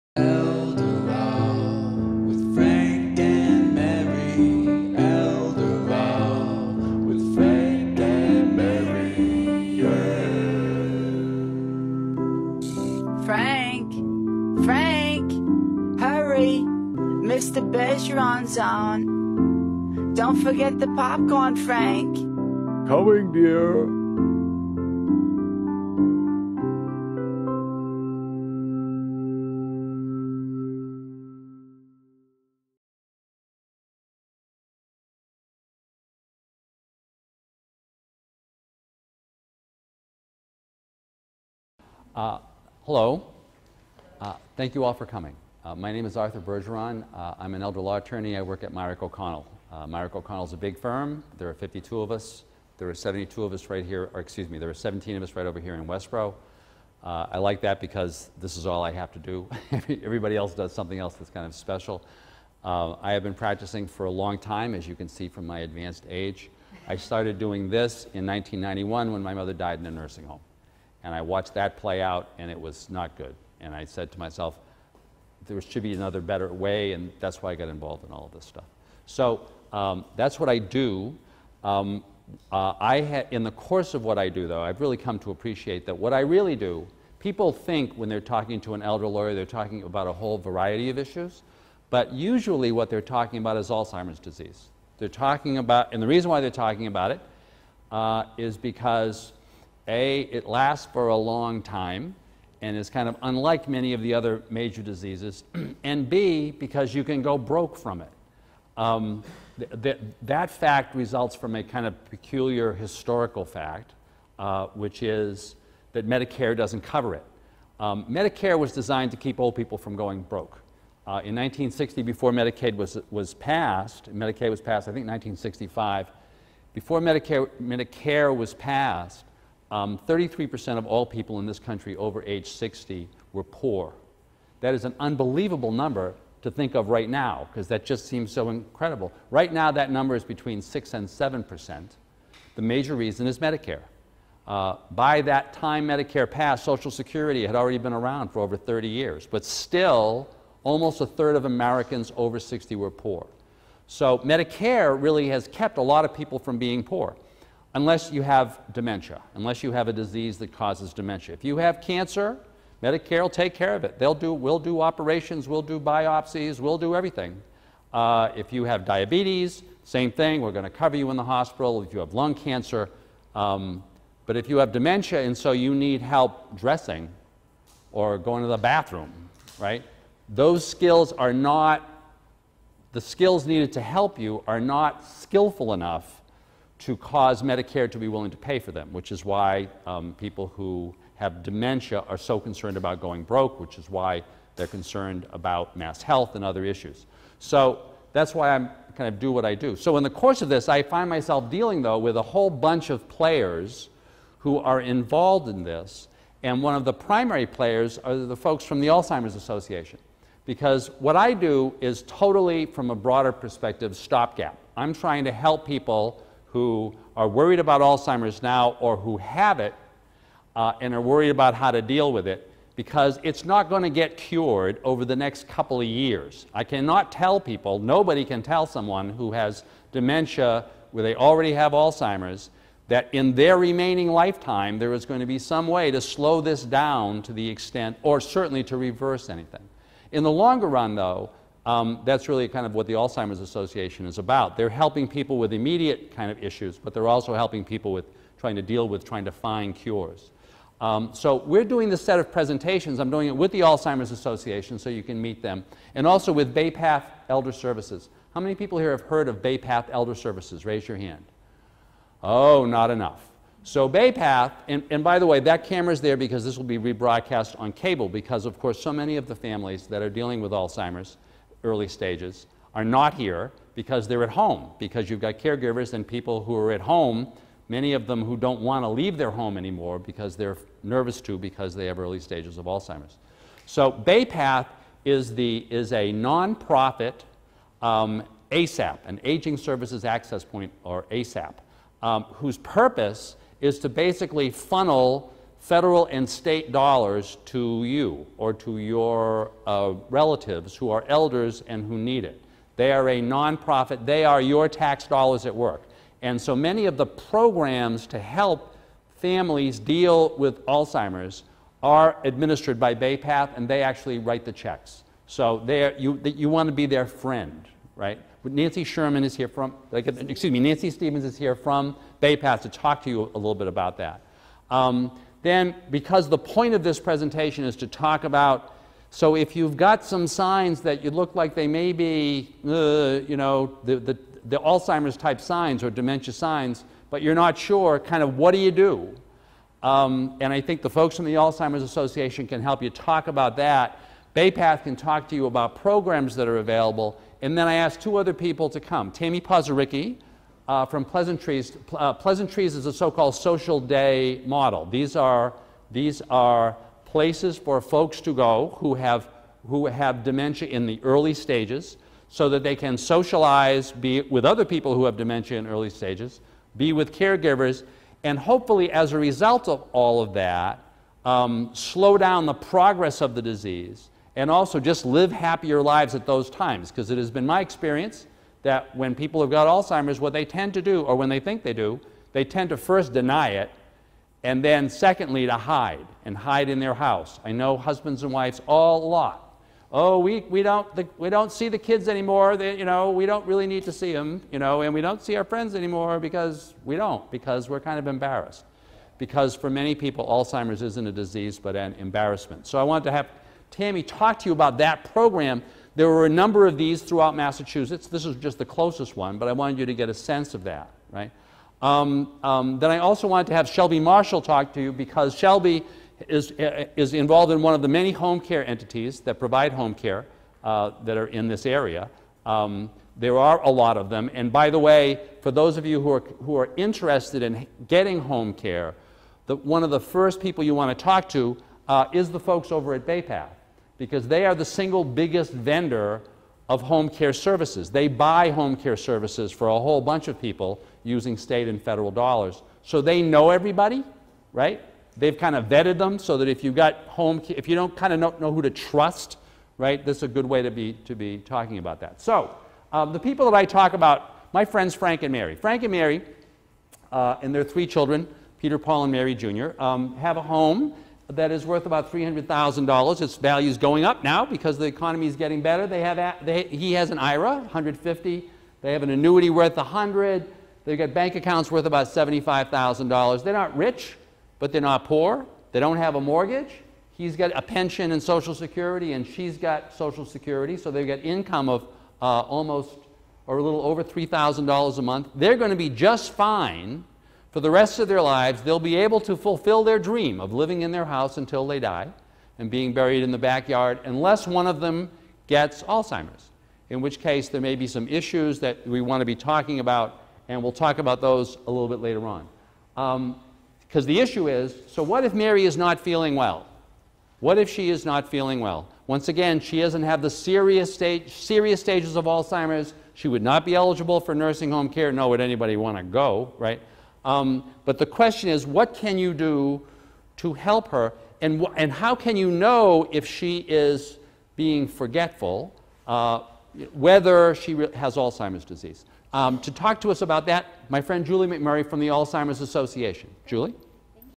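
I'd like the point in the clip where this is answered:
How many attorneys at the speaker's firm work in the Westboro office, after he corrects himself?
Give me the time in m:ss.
0:54.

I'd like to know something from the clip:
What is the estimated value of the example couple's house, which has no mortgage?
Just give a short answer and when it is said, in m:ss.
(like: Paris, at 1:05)
$300,000, at 7:42.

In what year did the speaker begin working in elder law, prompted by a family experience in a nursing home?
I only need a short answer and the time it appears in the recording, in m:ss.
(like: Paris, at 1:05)
1991, at 1:08.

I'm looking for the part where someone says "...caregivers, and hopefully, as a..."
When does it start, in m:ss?
6:07.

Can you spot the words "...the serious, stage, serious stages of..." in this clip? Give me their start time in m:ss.
8:30.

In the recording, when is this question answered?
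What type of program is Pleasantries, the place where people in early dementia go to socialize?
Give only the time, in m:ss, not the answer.
5:53.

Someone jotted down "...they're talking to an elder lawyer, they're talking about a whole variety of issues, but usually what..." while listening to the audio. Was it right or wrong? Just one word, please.
right.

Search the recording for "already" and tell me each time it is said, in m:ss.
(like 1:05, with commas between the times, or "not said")
2:27, 3:51.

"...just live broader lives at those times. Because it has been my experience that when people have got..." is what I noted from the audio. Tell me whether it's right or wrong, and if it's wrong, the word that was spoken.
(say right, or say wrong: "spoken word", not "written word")
wrong: "happier", not "broader".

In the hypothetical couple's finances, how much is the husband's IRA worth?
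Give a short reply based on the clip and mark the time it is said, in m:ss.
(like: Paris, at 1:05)
$150,000, at 7:47.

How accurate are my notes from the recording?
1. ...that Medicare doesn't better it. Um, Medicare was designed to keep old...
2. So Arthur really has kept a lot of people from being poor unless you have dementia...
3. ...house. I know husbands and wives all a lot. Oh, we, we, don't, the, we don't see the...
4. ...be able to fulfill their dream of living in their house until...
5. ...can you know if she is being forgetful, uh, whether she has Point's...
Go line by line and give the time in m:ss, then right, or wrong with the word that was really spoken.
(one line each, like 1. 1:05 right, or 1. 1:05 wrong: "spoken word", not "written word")
1. 1:55 wrong: "cover", not "better"
2. 2:33 wrong: "Medicare", not "Arthur"
3. 6:26 right
4. 8:08 right
5. 8:42 wrong: "Alzheimer", not "Point".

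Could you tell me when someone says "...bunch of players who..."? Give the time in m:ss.
3:22.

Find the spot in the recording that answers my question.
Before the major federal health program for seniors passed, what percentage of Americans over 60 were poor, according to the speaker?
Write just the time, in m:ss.
2:09.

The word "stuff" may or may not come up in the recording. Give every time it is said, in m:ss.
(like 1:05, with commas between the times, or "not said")
1:18.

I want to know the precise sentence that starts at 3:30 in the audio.
Because what I do is totally, from a broader perspective, stopgap.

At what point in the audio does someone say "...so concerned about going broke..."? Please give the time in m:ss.
3:12.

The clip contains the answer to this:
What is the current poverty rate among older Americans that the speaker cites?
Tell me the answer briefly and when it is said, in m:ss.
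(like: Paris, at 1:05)
Between 6 and 7%, at 2:20.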